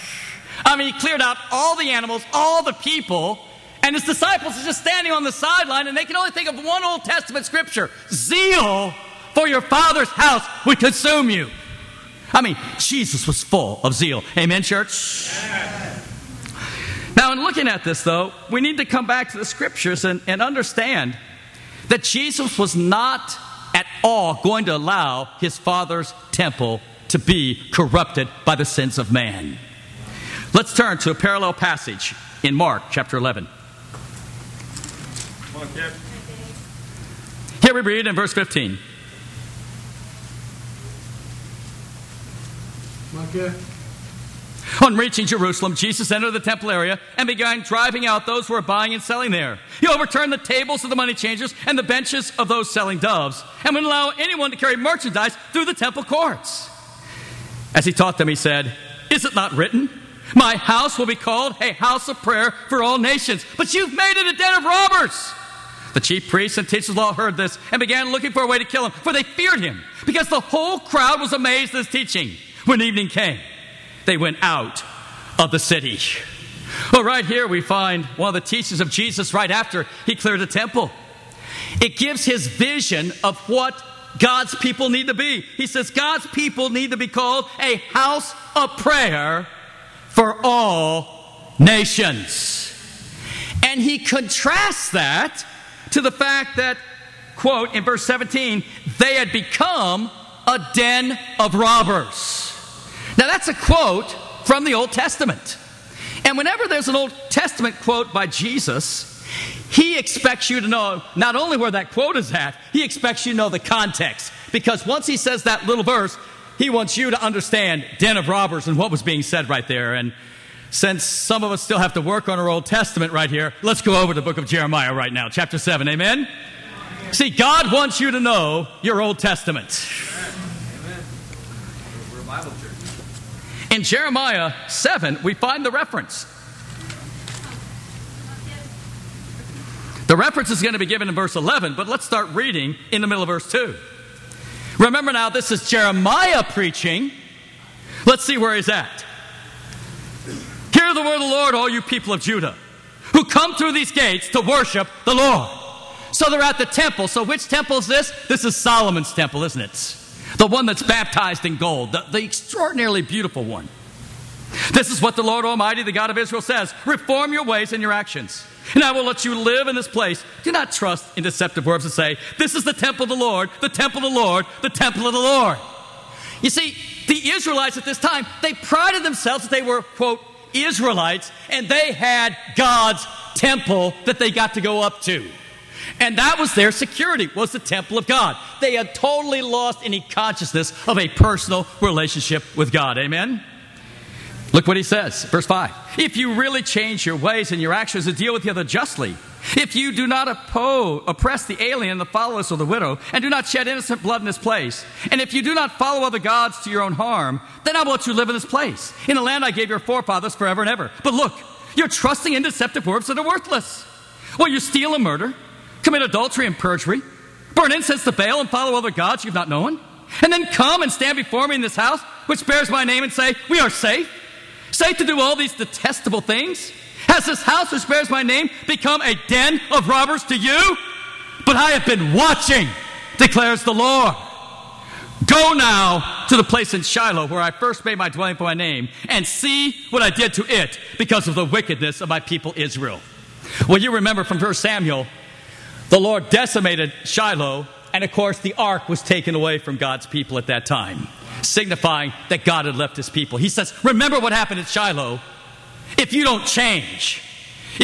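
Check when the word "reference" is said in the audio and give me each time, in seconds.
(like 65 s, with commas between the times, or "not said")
135 s, 140 s.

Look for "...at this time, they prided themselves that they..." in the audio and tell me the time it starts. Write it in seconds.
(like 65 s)
177 s.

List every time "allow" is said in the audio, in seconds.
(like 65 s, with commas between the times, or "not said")
24 s, 53 s.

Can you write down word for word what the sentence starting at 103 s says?
Now, that's a quote from the Old Testament.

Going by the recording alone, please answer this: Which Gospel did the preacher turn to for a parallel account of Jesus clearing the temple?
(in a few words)
Mark.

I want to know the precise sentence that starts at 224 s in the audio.
Safe to do all these detestable things?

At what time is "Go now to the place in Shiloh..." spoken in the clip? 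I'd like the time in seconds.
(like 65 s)
235 s.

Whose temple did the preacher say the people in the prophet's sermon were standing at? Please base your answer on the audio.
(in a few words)
Solomon's temple.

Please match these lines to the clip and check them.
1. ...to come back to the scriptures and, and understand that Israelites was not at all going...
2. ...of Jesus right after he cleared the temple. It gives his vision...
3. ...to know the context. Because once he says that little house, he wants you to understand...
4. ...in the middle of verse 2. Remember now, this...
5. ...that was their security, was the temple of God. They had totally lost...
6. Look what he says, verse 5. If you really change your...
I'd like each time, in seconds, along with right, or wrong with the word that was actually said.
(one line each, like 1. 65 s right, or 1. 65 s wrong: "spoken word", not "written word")
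1. 18 s wrong: "Jesus", not "Israelites"
2. 78 s right
3. 113 s wrong: "verse", not "house"
4. 142 s right
5. 186 s right
6. 194 s right.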